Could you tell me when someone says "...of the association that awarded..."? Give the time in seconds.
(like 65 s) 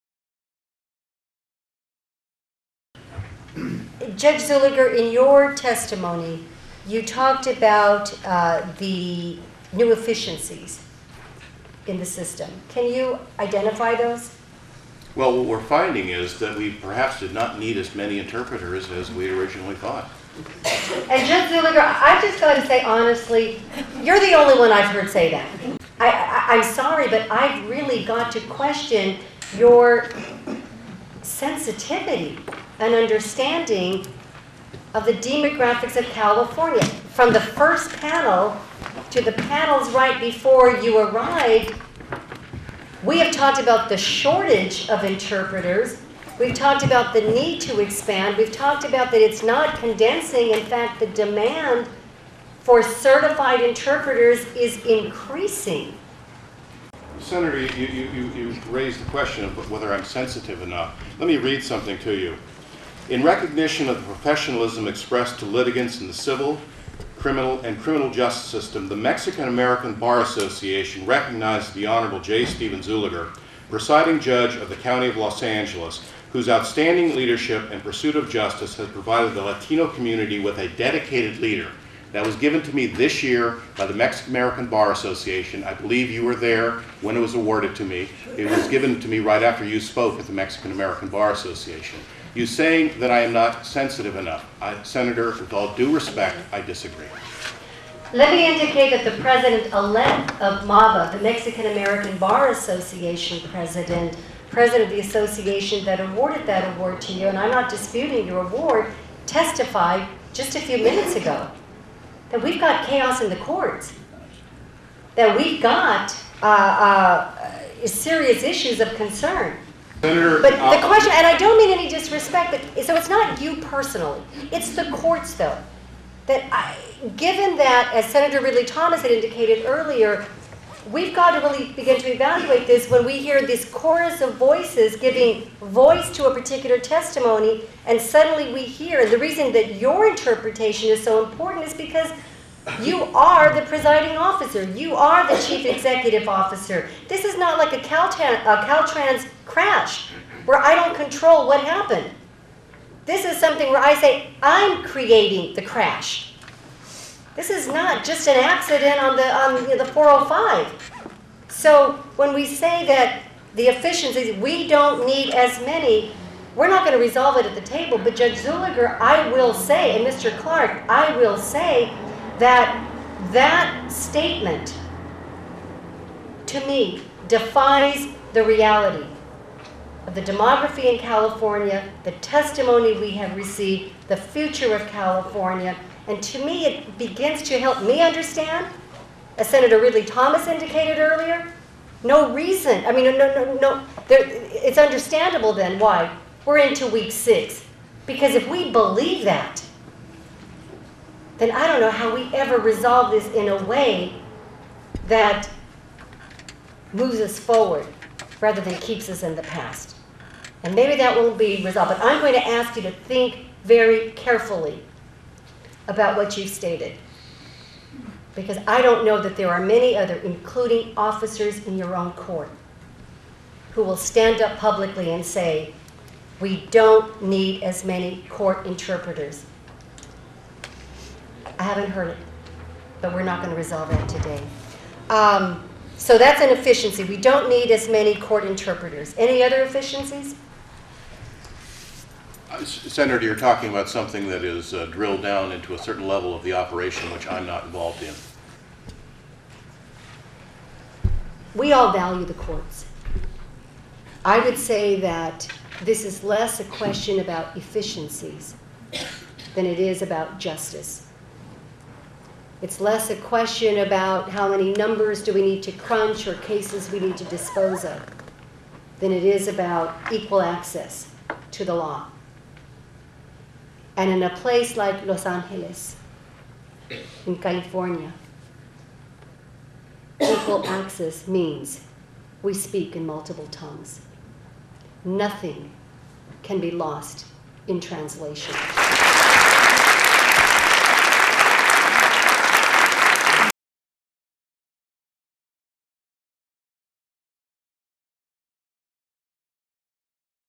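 104 s.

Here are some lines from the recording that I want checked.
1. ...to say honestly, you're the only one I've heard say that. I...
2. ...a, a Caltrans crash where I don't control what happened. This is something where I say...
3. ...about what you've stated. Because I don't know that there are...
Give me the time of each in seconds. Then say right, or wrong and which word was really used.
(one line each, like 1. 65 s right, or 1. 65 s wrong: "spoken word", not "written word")
1. 22 s right
2. 147 s right
3. 215 s right.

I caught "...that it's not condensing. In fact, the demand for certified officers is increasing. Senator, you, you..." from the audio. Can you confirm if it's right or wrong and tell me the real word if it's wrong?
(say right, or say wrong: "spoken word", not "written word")
wrong: "interpreters", not "officers".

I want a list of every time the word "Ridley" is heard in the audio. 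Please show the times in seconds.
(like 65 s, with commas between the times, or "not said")
128 s, 189 s.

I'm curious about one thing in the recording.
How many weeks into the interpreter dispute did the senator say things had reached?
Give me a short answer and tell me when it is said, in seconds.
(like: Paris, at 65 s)
6, at 196 s.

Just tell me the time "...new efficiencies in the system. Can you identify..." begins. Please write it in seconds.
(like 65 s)
9 s.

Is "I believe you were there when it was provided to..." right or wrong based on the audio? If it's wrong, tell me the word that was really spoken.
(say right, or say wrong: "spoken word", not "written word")
wrong: "awarded", not "provided".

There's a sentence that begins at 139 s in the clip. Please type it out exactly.
And the reason that your interpretation is so important is because you are the presiding officer.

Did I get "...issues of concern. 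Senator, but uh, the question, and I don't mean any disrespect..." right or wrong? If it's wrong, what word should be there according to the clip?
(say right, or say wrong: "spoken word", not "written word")
right.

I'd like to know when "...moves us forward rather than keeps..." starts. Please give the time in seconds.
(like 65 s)
206 s.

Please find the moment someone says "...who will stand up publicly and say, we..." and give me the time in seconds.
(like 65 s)
223 s.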